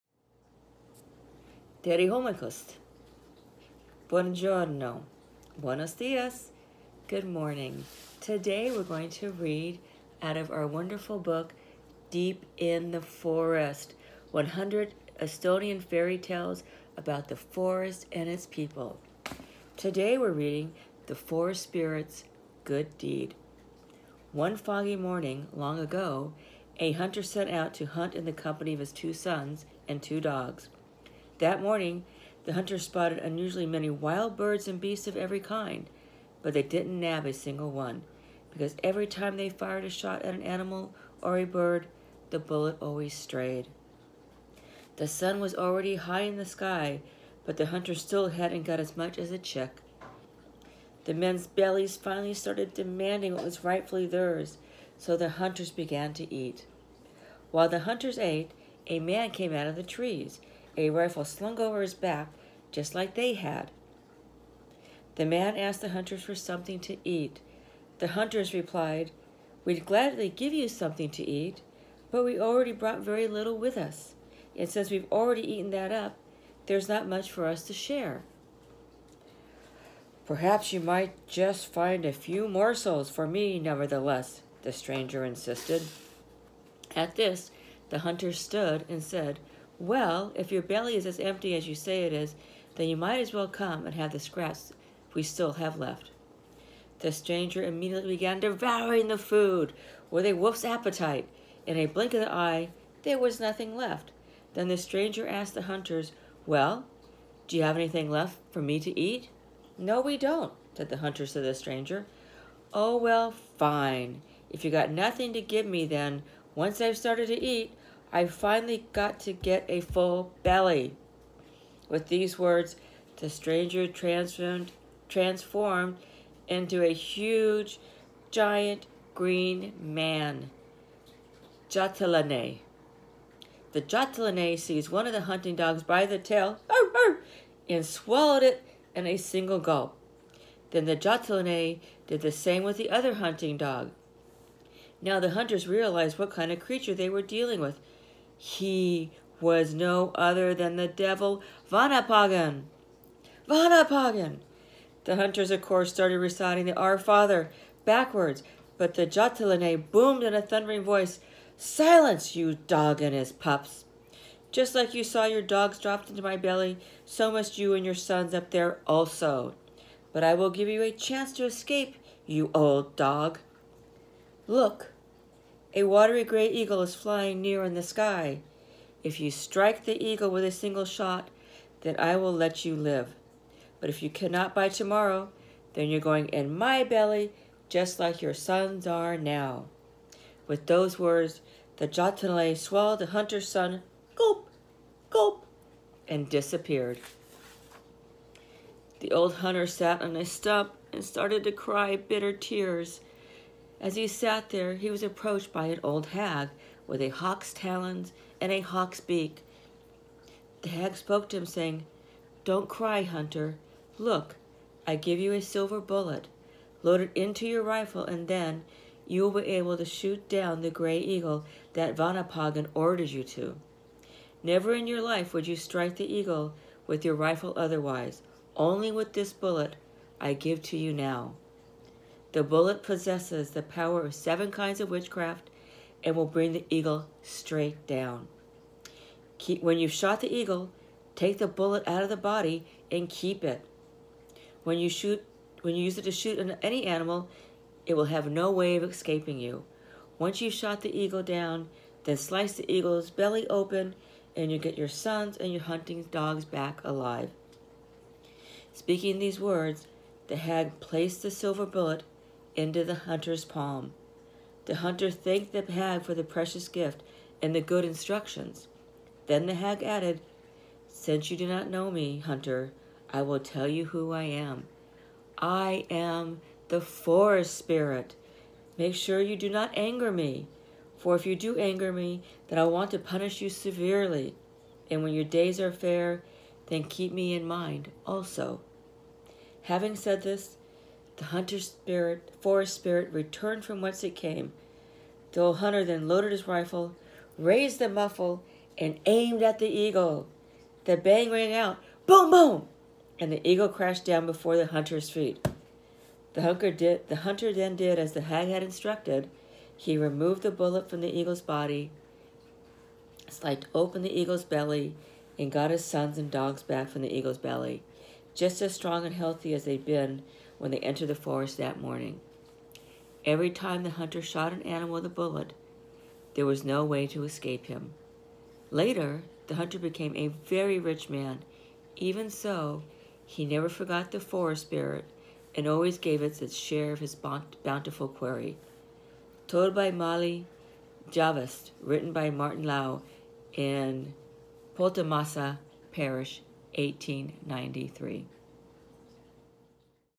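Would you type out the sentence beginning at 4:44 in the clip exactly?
And when your days are fair, then keep me in mind also.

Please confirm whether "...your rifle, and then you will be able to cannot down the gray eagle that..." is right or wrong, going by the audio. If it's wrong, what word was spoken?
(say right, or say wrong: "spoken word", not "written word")
wrong: "shoot", not "cannot".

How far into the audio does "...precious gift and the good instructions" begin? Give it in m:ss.
4:26.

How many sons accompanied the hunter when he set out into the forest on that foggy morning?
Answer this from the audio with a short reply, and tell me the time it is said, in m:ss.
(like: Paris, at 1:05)
2, at 0:28.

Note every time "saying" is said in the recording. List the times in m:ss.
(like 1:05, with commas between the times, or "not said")
3:31.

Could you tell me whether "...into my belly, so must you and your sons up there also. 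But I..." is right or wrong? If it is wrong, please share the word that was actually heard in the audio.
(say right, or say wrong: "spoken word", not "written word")
right.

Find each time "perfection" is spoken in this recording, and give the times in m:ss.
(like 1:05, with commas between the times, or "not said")
not said.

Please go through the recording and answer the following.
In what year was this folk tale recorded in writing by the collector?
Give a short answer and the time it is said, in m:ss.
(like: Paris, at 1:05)
1893, at 5:46.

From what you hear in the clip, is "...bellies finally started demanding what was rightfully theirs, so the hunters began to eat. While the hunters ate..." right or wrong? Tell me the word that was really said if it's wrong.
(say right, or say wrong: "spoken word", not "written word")
right.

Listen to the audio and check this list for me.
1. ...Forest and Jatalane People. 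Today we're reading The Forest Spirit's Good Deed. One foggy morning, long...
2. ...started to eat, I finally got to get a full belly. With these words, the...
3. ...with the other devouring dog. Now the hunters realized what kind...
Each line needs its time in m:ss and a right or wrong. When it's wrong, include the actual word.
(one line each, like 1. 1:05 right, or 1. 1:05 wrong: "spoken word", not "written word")
1. 0:17 wrong: "Its", not "Jatalane"
2. 1:56 right
3. 2:22 wrong: "hunting", not "devouring".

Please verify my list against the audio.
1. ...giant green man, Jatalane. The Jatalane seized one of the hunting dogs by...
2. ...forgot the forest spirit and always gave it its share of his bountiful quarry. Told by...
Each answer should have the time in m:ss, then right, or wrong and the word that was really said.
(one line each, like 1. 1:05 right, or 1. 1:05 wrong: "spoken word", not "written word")
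1. 2:08 right
2. 5:33 right.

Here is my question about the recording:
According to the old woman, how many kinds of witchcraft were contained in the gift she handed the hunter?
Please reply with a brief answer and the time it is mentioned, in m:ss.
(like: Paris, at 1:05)
7, at 3:54.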